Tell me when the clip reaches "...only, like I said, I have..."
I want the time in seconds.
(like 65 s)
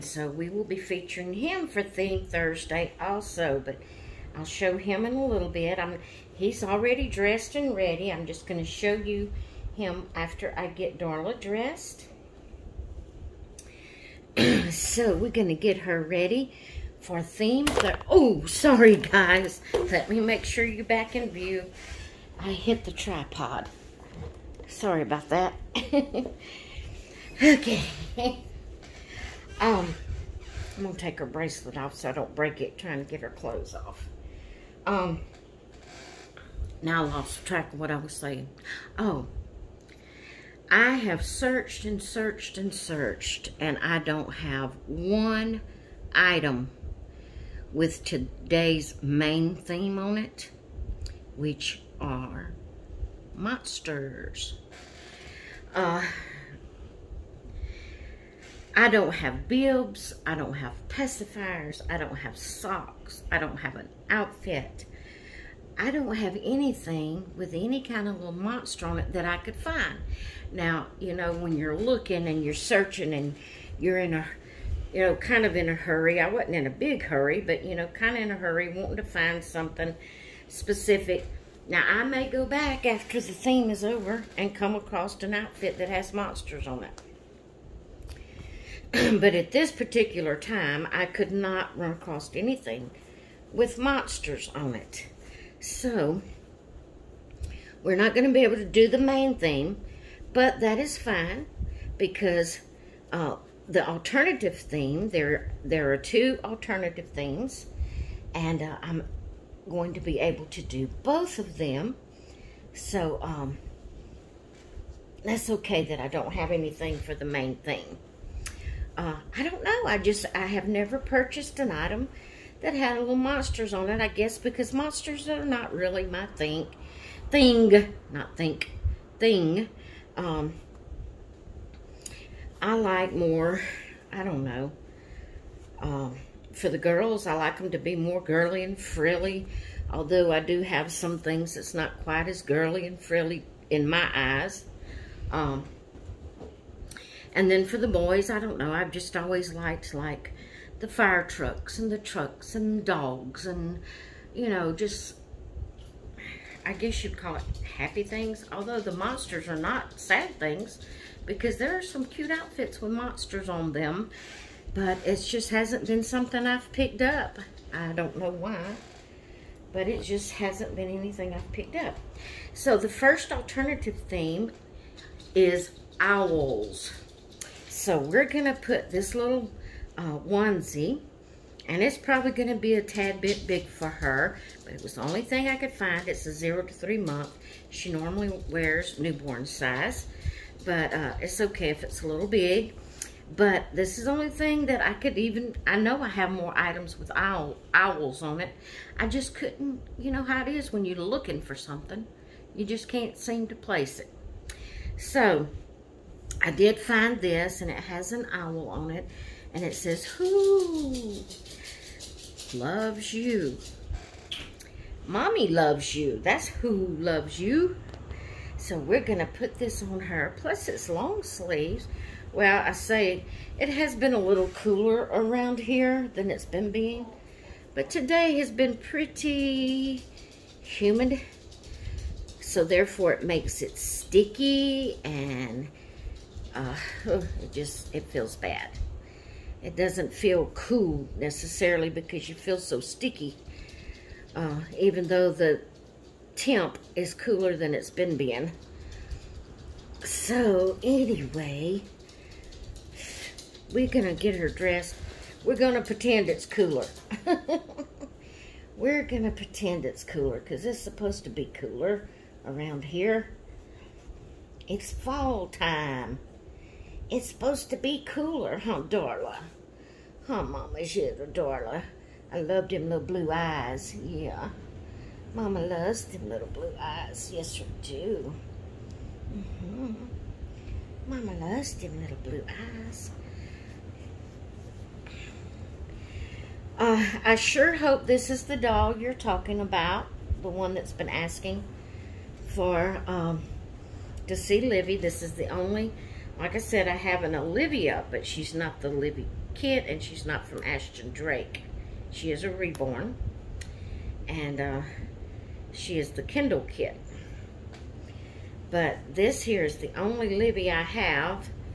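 295 s.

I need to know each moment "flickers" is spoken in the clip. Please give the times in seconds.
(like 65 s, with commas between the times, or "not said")
not said.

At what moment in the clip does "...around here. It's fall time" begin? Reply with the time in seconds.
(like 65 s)
262 s.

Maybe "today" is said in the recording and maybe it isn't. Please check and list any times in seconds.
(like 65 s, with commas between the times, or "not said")
48 s, 227 s.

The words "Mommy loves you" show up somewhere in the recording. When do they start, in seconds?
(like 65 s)
215 s.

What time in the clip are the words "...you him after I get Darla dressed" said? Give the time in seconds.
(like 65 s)
8 s.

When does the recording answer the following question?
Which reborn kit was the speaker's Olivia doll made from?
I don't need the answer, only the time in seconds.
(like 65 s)
306 s.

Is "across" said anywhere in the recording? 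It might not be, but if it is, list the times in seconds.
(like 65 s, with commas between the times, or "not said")
84 s, 91 s.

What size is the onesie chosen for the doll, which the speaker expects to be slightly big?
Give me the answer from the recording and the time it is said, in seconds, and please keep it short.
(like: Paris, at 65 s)
0 to 3 months, at 186 s.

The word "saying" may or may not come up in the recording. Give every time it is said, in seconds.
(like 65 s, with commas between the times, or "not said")
38 s.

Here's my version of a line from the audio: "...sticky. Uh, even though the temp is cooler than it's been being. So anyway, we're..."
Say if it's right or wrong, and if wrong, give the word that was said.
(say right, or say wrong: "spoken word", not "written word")
right.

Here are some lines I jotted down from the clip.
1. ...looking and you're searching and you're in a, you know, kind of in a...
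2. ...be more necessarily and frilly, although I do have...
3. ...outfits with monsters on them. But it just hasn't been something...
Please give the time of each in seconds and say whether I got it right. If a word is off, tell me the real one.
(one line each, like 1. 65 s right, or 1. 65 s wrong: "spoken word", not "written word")
1. 71 s right
2. 137 s wrong: "girly", not "necessarily"
3. 162 s right.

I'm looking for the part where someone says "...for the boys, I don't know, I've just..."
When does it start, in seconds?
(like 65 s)
147 s.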